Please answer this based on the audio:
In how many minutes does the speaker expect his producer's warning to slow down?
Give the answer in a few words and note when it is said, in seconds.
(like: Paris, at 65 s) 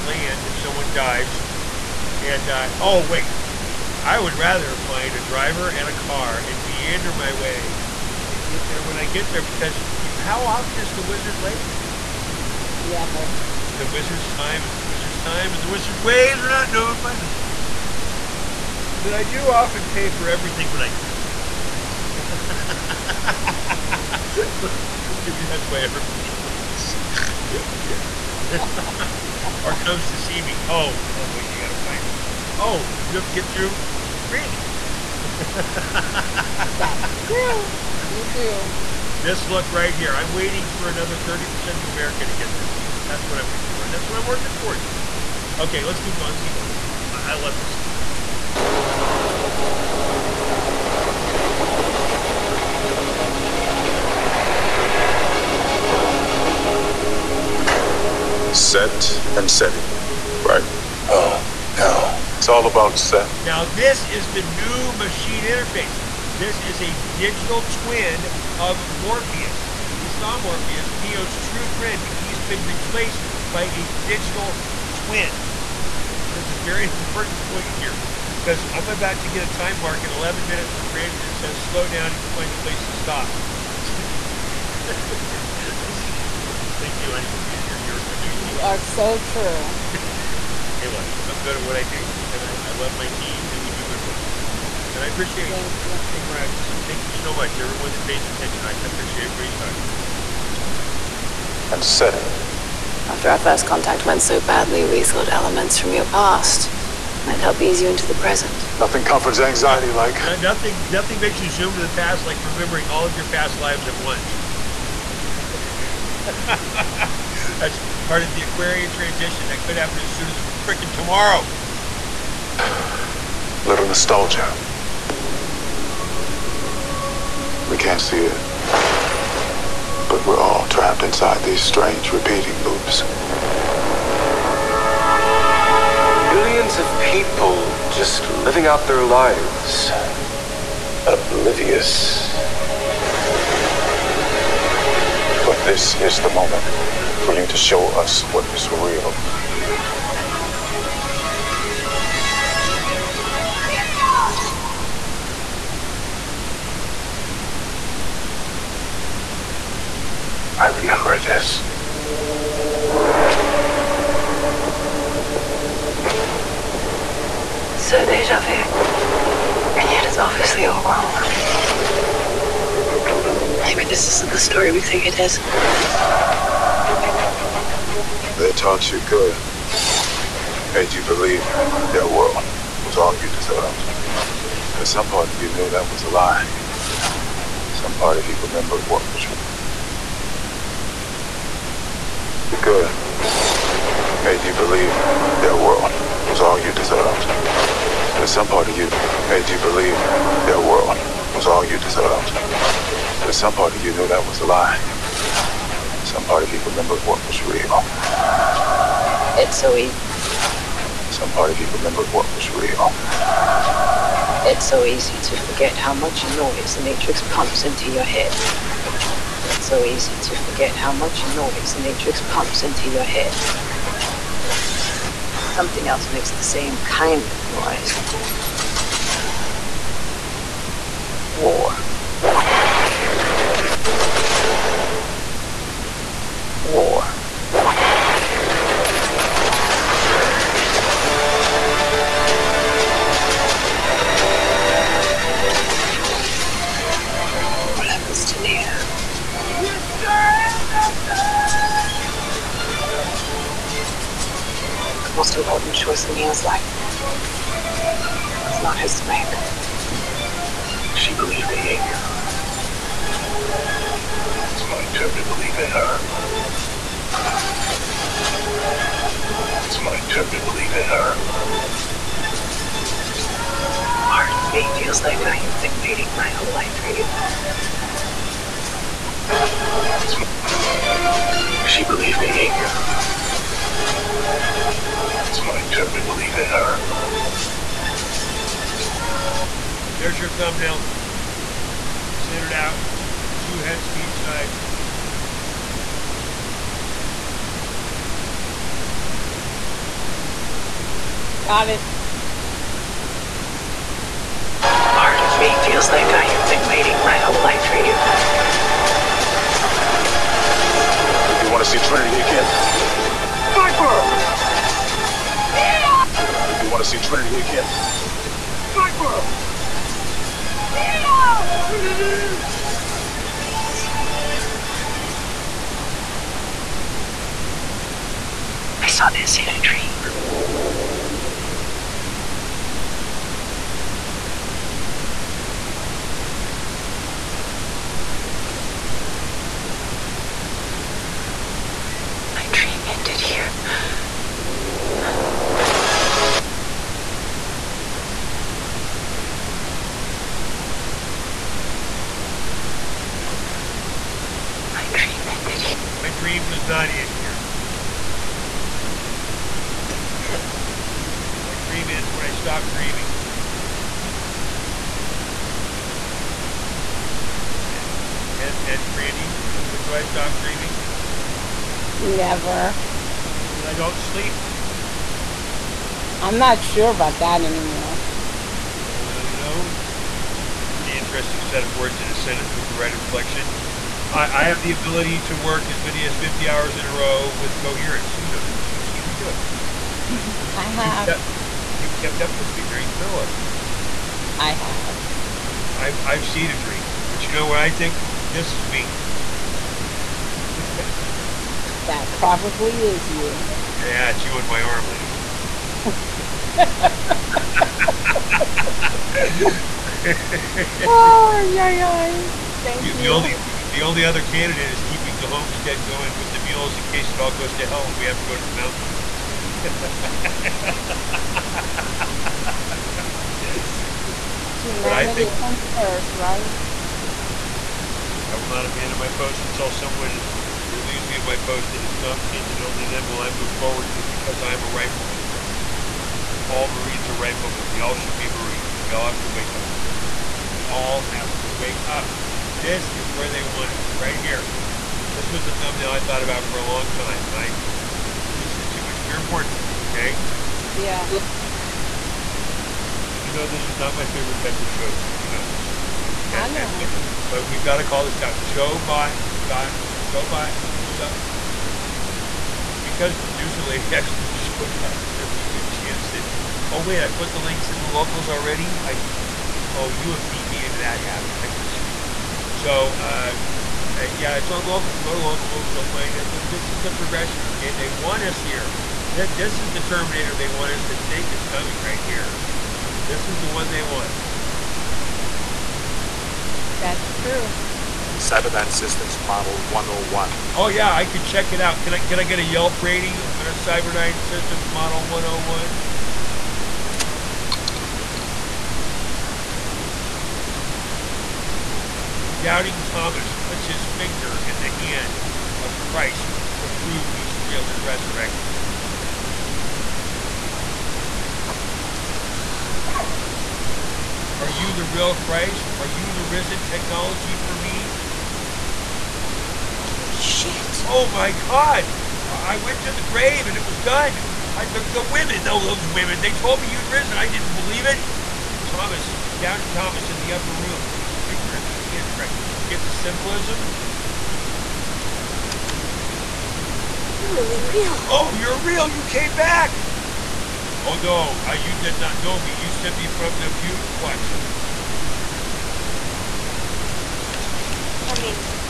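11, at 80 s.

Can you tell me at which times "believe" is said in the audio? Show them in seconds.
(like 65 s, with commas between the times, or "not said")
181 s, 194 s, 199 s, 527 s.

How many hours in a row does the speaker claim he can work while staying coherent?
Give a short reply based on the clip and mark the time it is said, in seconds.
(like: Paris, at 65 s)
50, at 386 s.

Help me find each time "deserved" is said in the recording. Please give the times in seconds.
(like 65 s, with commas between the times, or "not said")
183 s, 196 s, 201 s.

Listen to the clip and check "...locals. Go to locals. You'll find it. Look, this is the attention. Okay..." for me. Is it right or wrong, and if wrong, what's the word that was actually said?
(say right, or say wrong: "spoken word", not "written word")
wrong: "progression", not "attention".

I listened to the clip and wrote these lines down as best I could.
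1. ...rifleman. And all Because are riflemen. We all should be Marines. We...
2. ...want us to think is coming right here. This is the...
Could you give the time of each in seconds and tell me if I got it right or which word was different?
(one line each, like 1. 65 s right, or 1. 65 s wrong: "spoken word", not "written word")
1. 434 s wrong: "Marines", not "Because"
2. 480 s right.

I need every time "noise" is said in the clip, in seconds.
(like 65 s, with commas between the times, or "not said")
216 s, 221 s, 227 s.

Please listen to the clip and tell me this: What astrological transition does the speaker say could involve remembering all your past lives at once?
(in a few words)
Aquarian transition.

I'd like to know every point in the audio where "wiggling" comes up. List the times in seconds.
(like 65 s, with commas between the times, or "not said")
not said.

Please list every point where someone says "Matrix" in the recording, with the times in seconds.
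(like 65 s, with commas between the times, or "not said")
216 s, 221 s.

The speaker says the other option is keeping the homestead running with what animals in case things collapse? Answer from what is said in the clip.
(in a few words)
Mules.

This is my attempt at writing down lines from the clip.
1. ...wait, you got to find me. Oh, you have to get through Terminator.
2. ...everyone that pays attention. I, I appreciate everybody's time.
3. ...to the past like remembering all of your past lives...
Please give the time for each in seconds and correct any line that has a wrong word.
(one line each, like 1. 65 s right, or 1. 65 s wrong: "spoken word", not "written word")
1. 31 s wrong: "Brandy", not "Terminator"
2. 97 s right
3. 111 s right.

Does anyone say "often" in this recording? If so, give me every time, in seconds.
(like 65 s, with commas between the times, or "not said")
10 s, 19 s.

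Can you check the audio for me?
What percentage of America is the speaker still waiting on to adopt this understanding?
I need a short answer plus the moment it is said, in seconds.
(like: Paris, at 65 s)
30%, at 41 s.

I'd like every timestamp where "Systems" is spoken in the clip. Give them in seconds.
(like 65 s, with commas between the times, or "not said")
488 s, 494 s.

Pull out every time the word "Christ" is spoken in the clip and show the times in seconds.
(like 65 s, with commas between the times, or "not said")
505 s, 515 s, 532 s.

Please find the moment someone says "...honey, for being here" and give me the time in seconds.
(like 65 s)
87 s.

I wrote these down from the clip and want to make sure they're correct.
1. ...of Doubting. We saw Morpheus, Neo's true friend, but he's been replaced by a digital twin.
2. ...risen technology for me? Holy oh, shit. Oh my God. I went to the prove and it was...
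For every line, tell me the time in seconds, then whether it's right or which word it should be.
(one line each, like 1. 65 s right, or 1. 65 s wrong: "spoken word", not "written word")
1. 68 s wrong: "Morpheus", not "Doubting"
2. 516 s wrong: "grave", not "prove".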